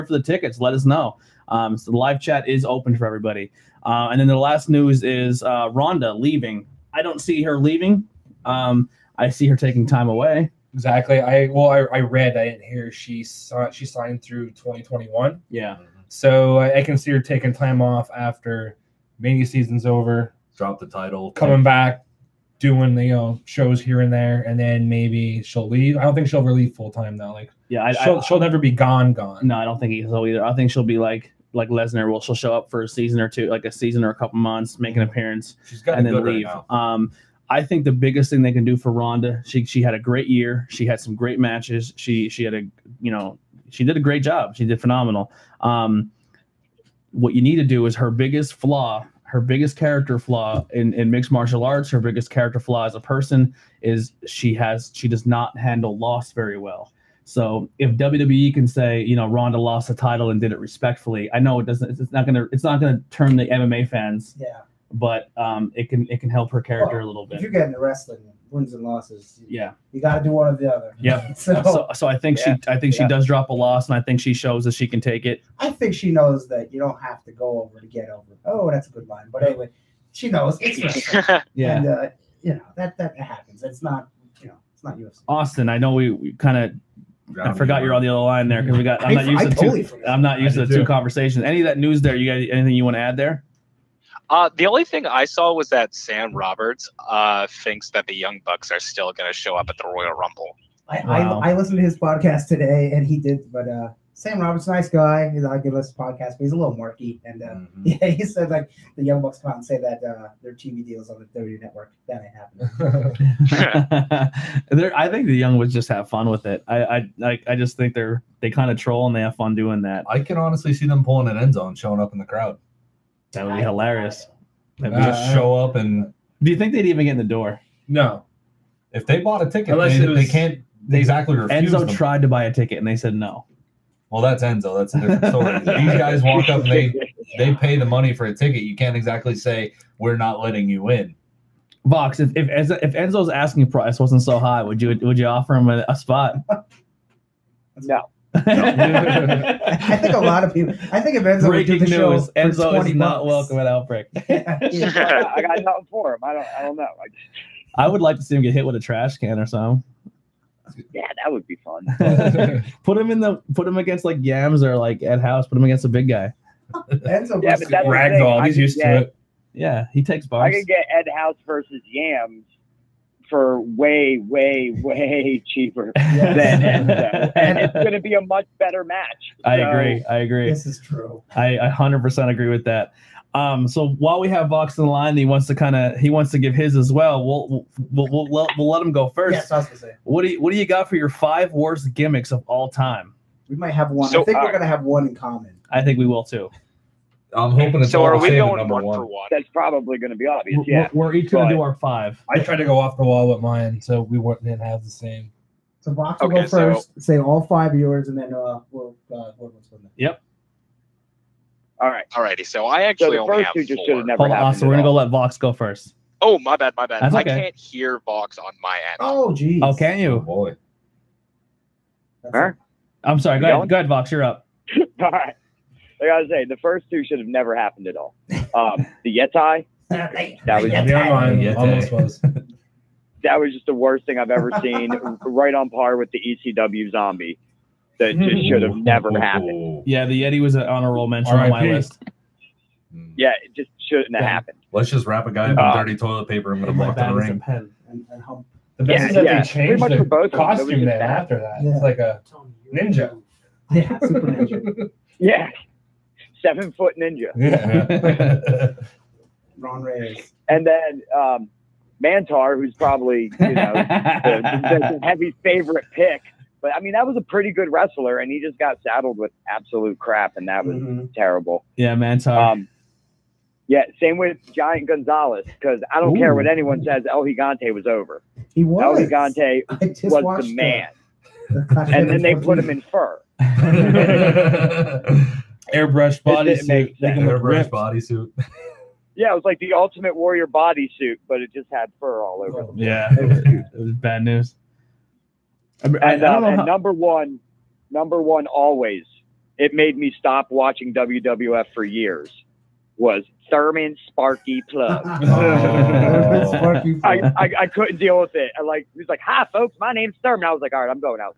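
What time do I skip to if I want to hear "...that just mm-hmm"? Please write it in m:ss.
3:57.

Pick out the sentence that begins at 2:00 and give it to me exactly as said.
I can honestly see them pulling an Enzo, showing up in the crowd.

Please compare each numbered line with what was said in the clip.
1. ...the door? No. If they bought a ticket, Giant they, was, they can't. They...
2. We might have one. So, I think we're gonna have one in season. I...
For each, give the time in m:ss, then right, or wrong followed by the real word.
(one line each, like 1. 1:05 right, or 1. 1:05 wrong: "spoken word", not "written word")
1. 2:07 wrong: "Unless", not "Giant"
2. 3:13 wrong: "common", not "season".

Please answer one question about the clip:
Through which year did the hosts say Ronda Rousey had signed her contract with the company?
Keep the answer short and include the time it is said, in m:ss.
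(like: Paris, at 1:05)
2021, at 0:14.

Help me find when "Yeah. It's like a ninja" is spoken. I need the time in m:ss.
4:11.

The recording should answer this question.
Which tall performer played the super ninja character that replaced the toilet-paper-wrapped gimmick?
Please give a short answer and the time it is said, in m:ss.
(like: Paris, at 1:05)
Ron Reis, at 4:19.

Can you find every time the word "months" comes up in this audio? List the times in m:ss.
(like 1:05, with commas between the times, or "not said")
0:34.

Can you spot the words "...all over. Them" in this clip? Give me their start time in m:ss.
4:52.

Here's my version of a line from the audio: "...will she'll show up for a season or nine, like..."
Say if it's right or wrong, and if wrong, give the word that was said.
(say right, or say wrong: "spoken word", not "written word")
wrong: "two", not "nine".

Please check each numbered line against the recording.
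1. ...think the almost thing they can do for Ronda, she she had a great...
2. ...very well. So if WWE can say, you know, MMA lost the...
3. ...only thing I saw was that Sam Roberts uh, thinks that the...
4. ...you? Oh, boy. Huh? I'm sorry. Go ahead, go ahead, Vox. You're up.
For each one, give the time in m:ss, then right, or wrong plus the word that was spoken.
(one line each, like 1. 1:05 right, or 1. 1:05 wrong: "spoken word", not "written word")
1. 0:37 wrong: "biggest", not "almost"
2. 0:56 wrong: "Ronda", not "MMA"
3. 1:34 right
4. 3:39 right.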